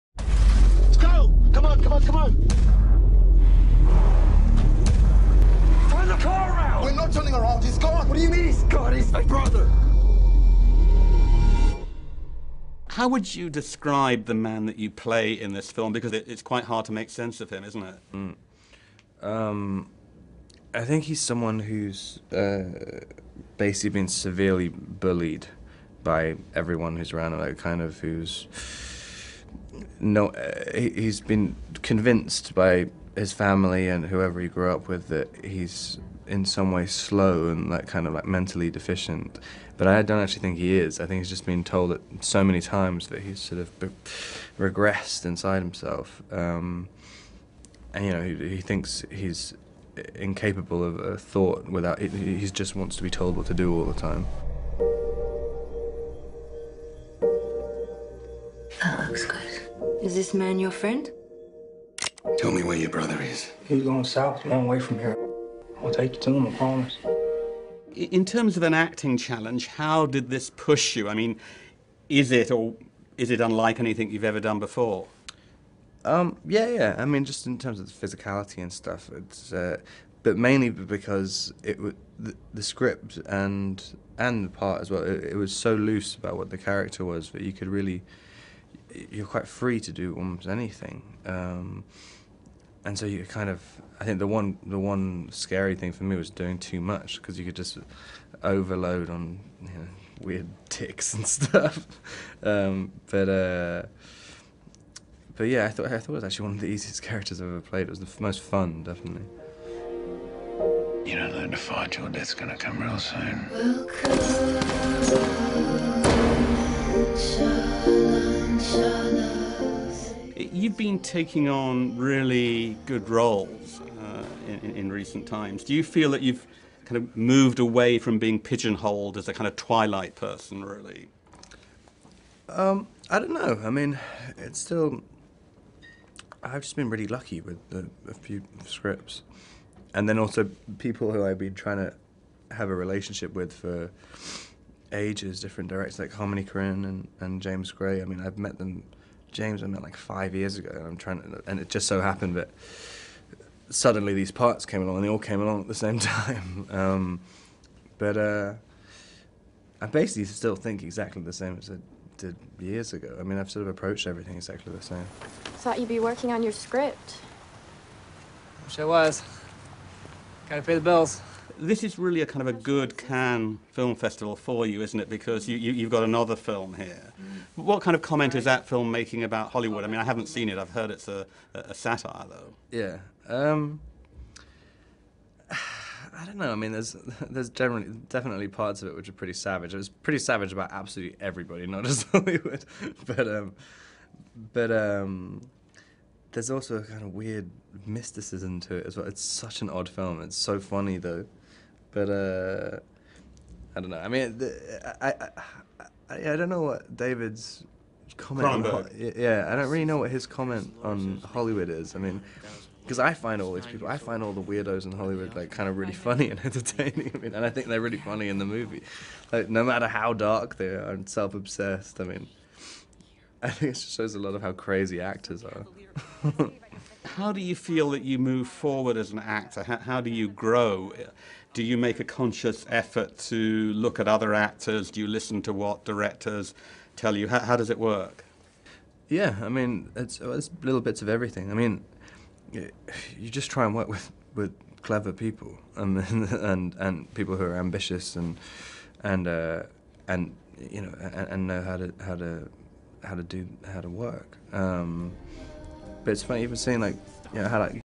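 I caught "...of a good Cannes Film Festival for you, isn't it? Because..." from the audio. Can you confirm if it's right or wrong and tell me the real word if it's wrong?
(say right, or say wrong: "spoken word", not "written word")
right.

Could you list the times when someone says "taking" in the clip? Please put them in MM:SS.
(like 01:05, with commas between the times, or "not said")
02:00.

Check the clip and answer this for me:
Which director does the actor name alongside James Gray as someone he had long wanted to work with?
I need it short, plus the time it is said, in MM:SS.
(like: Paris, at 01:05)
Harmony Korine, at 02:26.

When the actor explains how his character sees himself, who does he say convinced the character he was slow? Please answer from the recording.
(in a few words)
His family.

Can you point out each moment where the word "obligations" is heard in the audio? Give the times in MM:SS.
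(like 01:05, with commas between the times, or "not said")
not said.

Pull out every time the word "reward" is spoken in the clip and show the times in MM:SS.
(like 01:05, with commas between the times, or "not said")
not said.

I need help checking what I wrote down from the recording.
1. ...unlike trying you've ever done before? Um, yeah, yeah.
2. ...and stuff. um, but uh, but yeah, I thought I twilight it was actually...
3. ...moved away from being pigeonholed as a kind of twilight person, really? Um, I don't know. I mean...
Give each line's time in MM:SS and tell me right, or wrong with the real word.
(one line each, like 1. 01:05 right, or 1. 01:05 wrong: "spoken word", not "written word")
1. 01:13 wrong: "anything", not "trying"
2. 01:41 wrong: "thought", not "twilight"
3. 02:07 right.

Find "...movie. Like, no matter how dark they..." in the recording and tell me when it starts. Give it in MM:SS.
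03:38.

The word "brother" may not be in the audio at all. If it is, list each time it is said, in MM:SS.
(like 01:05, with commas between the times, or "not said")
00:09, 01:02.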